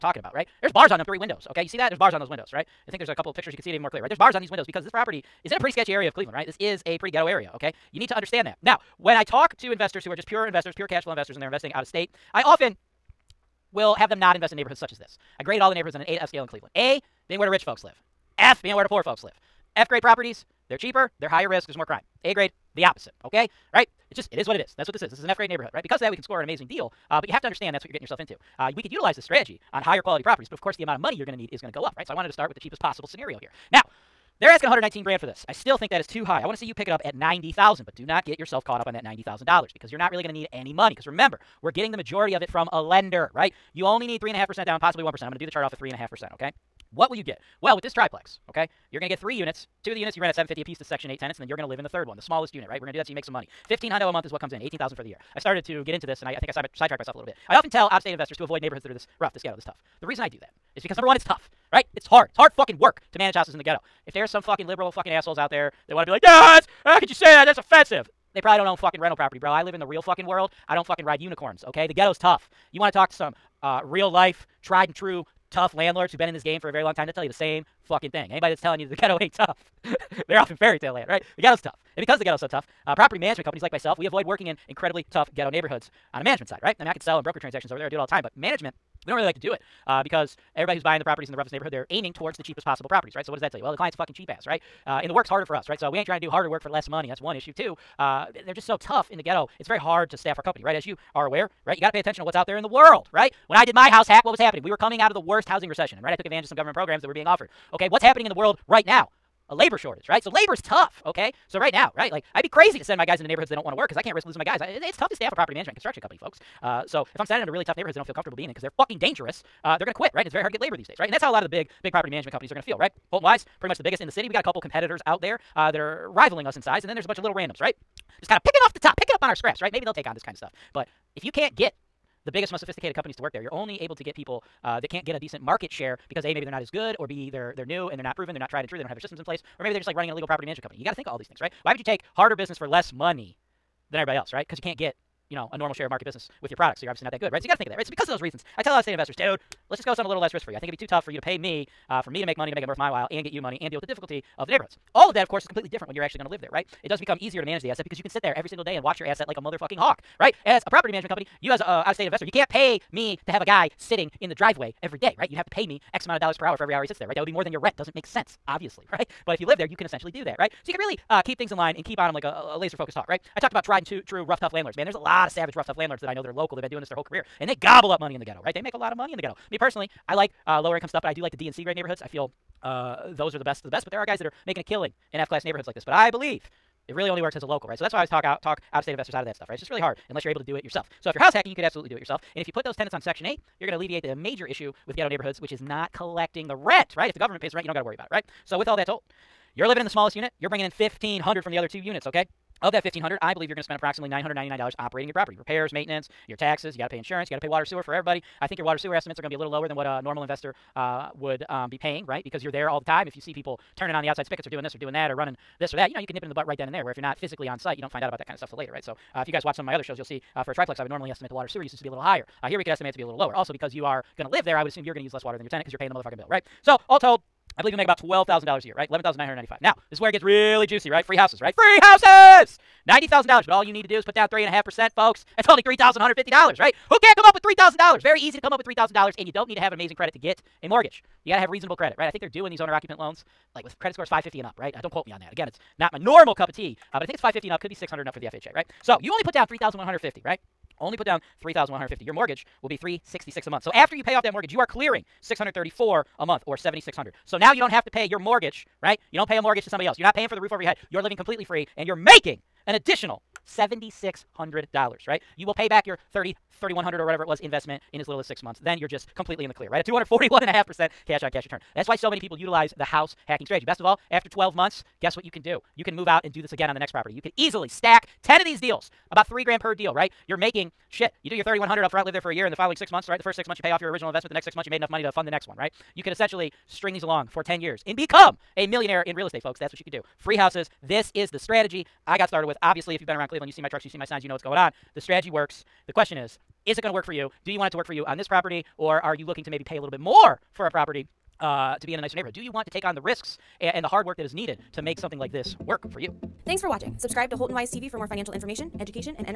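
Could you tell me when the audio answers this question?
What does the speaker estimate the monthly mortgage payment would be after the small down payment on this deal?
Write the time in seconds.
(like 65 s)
252 s.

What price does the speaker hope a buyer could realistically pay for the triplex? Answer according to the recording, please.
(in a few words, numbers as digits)
$90,000.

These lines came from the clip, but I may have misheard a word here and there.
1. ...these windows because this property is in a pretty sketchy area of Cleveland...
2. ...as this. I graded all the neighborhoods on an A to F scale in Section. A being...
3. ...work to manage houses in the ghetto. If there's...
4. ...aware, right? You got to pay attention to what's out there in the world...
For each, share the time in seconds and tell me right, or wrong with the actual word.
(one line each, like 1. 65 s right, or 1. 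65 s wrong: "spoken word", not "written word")
1. 4 s right
2. 14 s wrong: "Cleveland", not "Section"
3. 62 s right
4. 101 s right.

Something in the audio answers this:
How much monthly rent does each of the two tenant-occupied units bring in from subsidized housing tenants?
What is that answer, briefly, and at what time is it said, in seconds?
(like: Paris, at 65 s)
$750, at 50 s.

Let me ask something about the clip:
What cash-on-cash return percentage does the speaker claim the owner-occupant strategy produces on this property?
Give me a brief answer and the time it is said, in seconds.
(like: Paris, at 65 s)
241.5%, at 269 s.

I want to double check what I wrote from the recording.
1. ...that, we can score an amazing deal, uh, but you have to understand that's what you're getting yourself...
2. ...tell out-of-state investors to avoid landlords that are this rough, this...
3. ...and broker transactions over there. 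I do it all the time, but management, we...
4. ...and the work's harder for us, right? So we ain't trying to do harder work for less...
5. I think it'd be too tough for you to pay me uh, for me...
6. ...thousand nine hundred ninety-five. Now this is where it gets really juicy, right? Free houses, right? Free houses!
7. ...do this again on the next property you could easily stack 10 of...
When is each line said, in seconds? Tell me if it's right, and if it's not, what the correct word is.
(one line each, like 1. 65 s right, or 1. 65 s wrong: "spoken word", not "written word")
1. 26 s right
2. 57 s wrong: "neighborhoods", not "landlords"
3. 87 s right
4. 95 s right
5. 150 s right
6. 229 s right
7. 276 s right.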